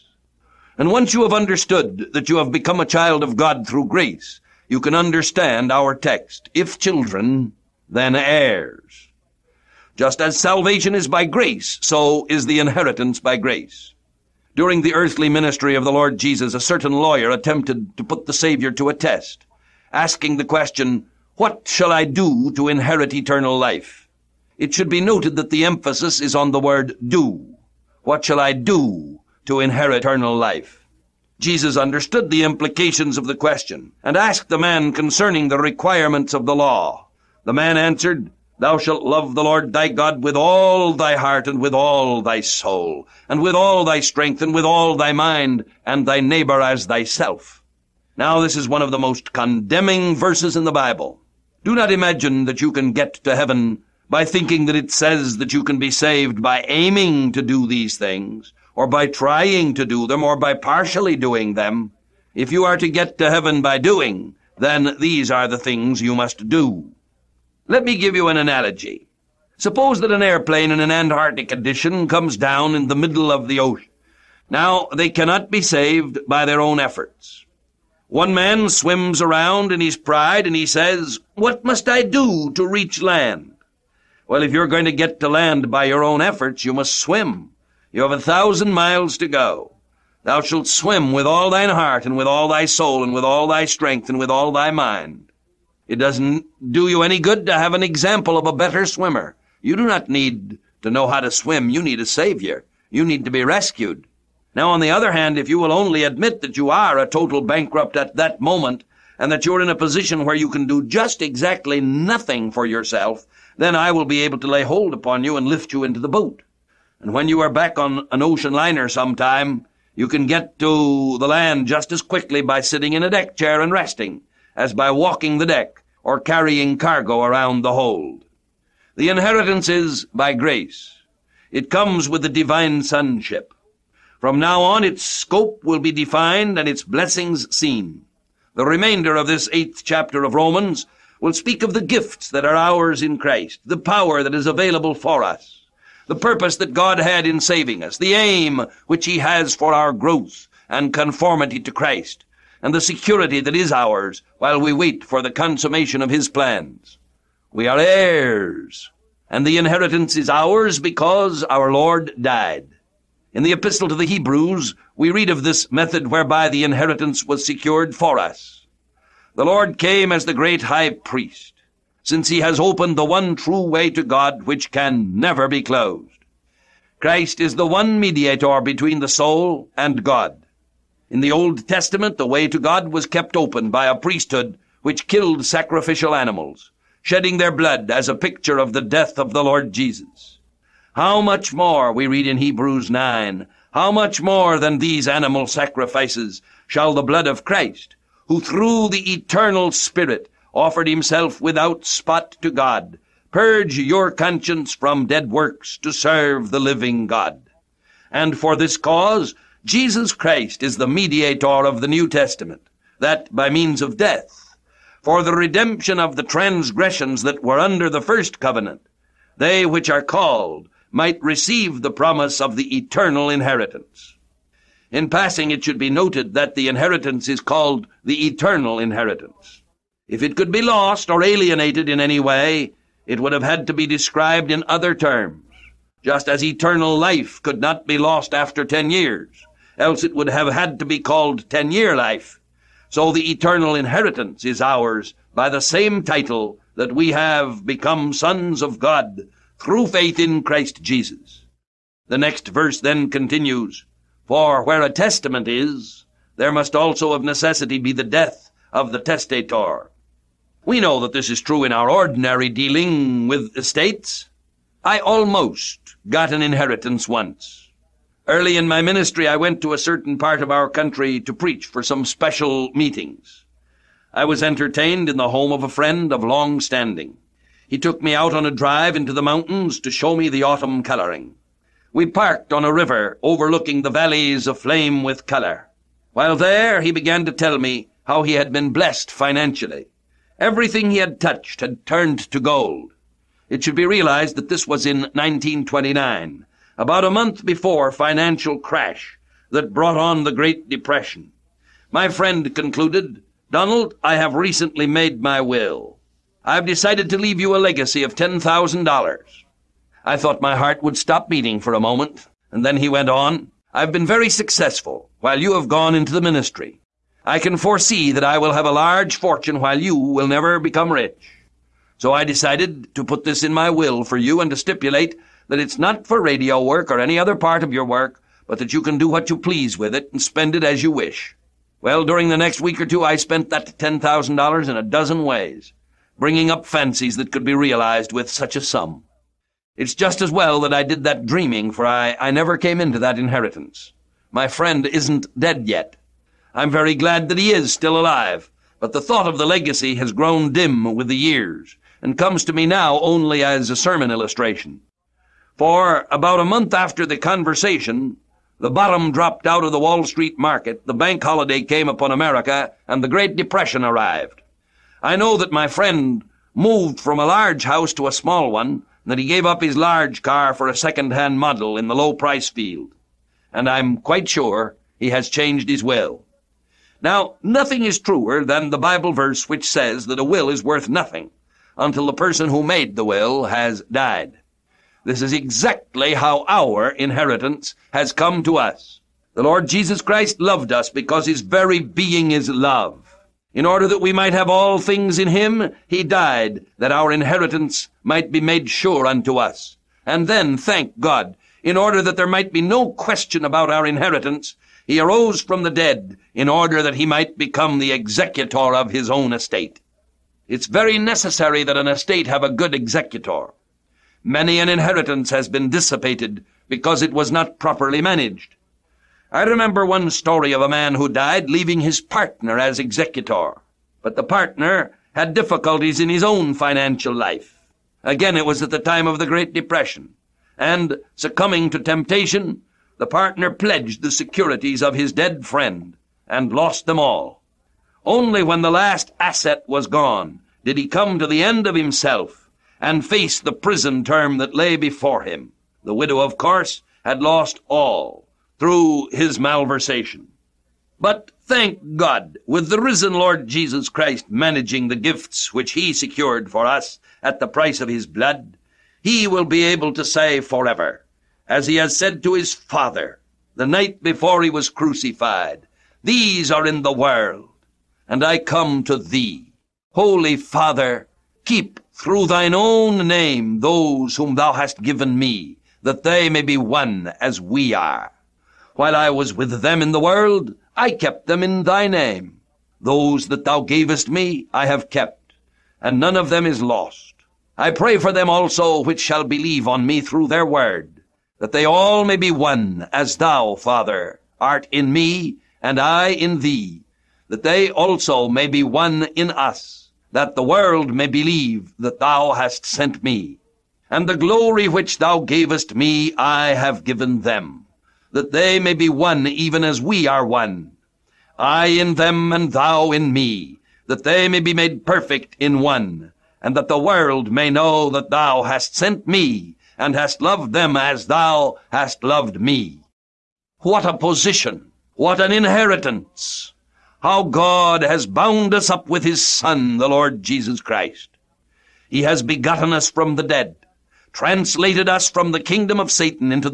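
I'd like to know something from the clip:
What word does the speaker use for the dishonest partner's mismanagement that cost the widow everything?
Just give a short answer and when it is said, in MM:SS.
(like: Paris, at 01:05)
malversation, at 07:29.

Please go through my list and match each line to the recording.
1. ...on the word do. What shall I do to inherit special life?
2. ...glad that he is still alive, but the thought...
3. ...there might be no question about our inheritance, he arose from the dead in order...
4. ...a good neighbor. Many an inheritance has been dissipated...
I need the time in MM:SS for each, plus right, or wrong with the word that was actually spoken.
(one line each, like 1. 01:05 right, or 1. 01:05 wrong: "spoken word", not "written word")
1. 00:26 wrong: "eternal", not "special"
2. 05:46 right
3. 06:42 right
4. 06:52 wrong: "executor", not "neighbor".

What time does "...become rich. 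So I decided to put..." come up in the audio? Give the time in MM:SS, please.
05:20.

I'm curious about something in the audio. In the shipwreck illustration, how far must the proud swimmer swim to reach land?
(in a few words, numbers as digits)
1,000 miles.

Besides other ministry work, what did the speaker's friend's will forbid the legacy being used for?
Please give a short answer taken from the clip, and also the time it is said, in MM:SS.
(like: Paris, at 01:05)
radio work, at 05:26.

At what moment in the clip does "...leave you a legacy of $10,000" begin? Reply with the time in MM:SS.
05:07.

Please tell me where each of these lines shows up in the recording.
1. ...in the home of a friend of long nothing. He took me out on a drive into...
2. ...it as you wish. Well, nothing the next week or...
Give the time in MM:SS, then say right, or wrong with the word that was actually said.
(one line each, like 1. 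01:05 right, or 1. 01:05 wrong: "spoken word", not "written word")
1. 04:35 wrong: "standing", not "nothing"
2. 05:30 wrong: "during", not "nothing".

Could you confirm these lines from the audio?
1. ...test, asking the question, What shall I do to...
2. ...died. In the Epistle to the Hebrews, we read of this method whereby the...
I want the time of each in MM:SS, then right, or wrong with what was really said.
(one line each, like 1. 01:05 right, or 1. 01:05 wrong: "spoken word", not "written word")
1. 00:18 right
2. 02:42 right.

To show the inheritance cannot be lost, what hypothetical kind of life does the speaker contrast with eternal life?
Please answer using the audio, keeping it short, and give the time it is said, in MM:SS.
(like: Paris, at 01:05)
ten-year life, at 04:01.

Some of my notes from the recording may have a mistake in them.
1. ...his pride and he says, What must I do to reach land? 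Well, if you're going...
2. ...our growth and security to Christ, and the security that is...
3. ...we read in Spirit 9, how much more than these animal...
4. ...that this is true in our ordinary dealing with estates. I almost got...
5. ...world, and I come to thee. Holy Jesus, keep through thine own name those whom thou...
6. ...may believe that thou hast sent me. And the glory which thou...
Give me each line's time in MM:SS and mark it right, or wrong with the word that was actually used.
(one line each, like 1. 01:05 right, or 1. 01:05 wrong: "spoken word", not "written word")
1. 01:19 right
2. 02:29 wrong: "conformity", not "security"
3. 03:11 wrong: "Hebrews", not "Spirit"
4. 04:21 right
5. 07:46 wrong: "Father", not "Jesus"
6. 08:20 right.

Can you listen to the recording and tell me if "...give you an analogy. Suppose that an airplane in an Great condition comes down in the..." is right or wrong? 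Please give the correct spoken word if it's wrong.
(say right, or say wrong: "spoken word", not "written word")
wrong: "Antarctic", not "Great".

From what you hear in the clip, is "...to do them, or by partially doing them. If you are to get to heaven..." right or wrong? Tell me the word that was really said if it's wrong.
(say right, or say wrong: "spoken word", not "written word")
right.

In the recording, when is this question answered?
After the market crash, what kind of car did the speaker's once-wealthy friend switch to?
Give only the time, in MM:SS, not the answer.
06:10.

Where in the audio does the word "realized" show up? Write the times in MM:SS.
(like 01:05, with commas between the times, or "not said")
04:53, 05:37.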